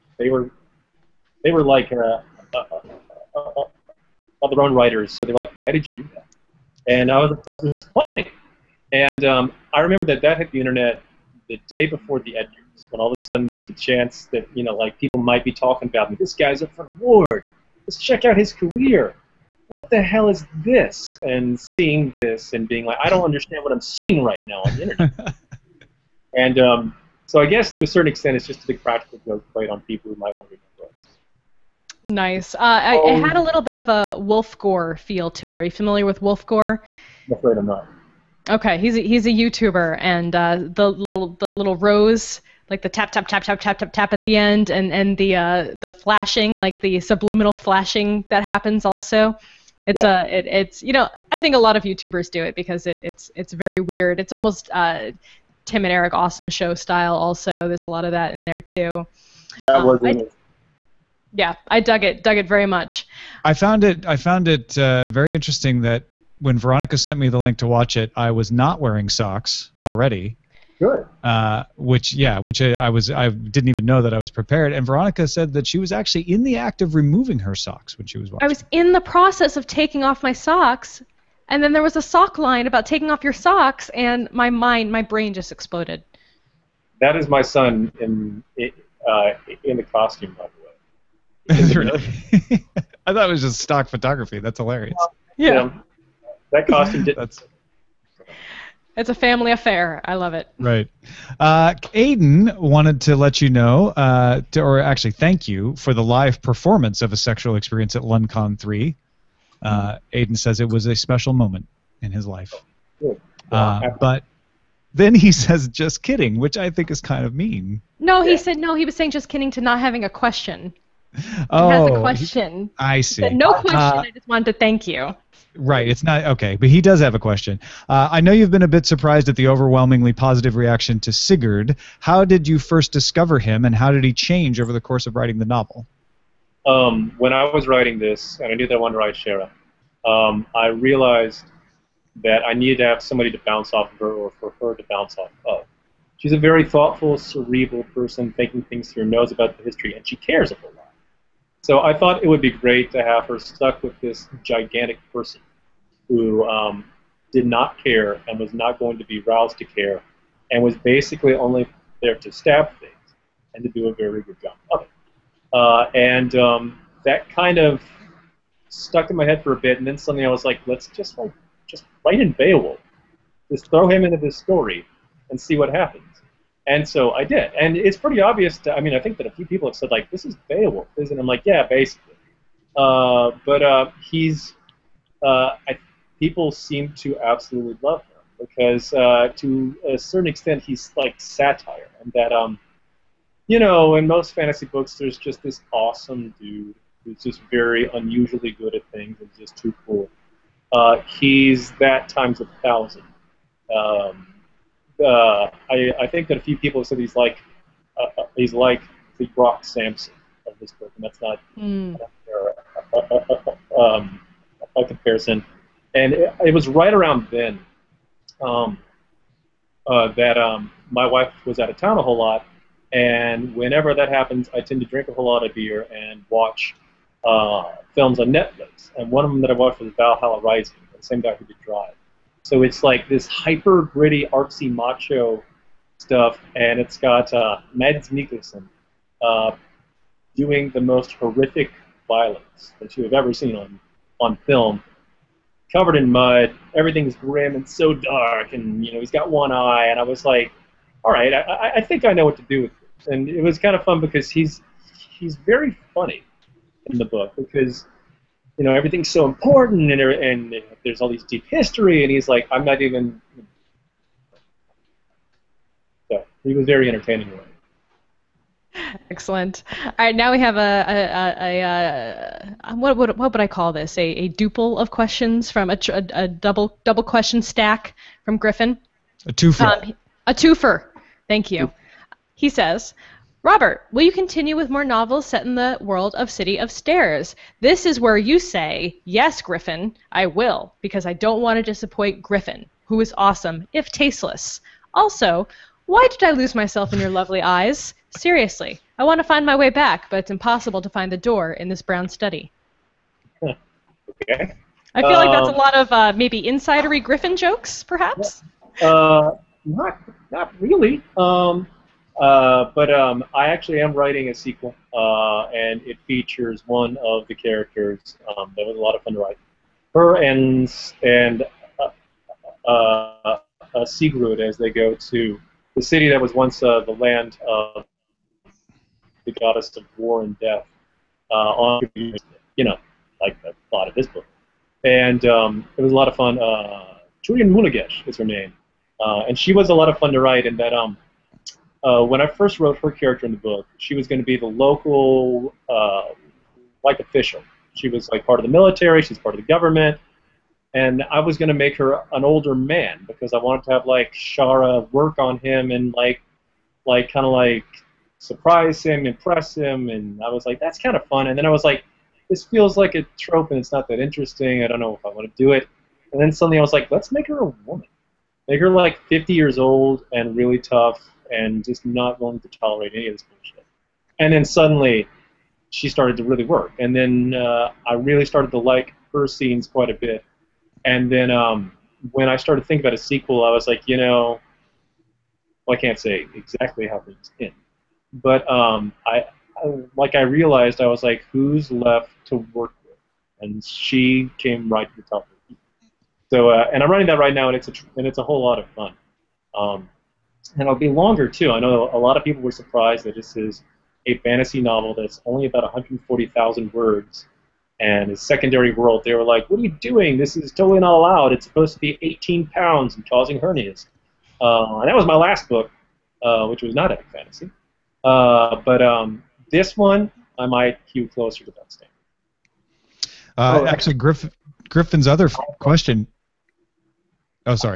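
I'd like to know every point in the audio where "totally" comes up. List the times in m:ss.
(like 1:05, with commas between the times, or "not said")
6:50.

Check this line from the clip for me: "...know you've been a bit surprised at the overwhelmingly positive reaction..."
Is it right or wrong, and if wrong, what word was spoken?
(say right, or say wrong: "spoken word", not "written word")
right.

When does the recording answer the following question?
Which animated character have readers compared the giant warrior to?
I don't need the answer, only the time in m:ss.
3:29.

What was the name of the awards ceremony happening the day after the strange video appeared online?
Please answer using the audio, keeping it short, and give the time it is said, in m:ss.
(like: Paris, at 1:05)
Edgar, at 0:12.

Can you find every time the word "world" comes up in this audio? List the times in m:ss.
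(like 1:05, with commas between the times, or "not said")
4:45, 6:48.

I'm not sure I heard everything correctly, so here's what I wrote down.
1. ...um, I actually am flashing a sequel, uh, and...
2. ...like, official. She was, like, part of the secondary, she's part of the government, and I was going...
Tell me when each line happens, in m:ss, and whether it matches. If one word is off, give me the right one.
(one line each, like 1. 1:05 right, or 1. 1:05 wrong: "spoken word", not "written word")
1. 5:12 wrong: "writing", not "flashing"
2. 5:46 wrong: "military", not "secondary".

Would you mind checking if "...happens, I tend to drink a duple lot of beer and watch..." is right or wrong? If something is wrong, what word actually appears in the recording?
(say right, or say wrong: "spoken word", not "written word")
wrong: "whole", not "duple".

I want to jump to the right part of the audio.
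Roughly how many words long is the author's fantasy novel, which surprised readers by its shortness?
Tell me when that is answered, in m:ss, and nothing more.
6:45.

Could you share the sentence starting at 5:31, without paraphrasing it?
on you know, like the plot of this book, and um, it was a lot of fun.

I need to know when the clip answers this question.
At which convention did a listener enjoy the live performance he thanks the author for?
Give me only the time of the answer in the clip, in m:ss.
1:48.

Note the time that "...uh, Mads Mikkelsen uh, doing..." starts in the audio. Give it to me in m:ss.
3:57.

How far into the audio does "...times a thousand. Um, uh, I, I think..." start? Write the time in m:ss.
3:22.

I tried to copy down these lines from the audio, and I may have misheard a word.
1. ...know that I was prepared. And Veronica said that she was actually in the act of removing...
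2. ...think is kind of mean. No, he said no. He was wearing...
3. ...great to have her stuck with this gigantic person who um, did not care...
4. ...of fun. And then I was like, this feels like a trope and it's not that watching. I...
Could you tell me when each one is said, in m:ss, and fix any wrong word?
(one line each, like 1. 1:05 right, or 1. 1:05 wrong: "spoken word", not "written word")
1. 1:13 right
2. 1:56 wrong: "saying", not "wearing"
3. 2:32 right
4. 6:00 wrong: "interesting", not "watching".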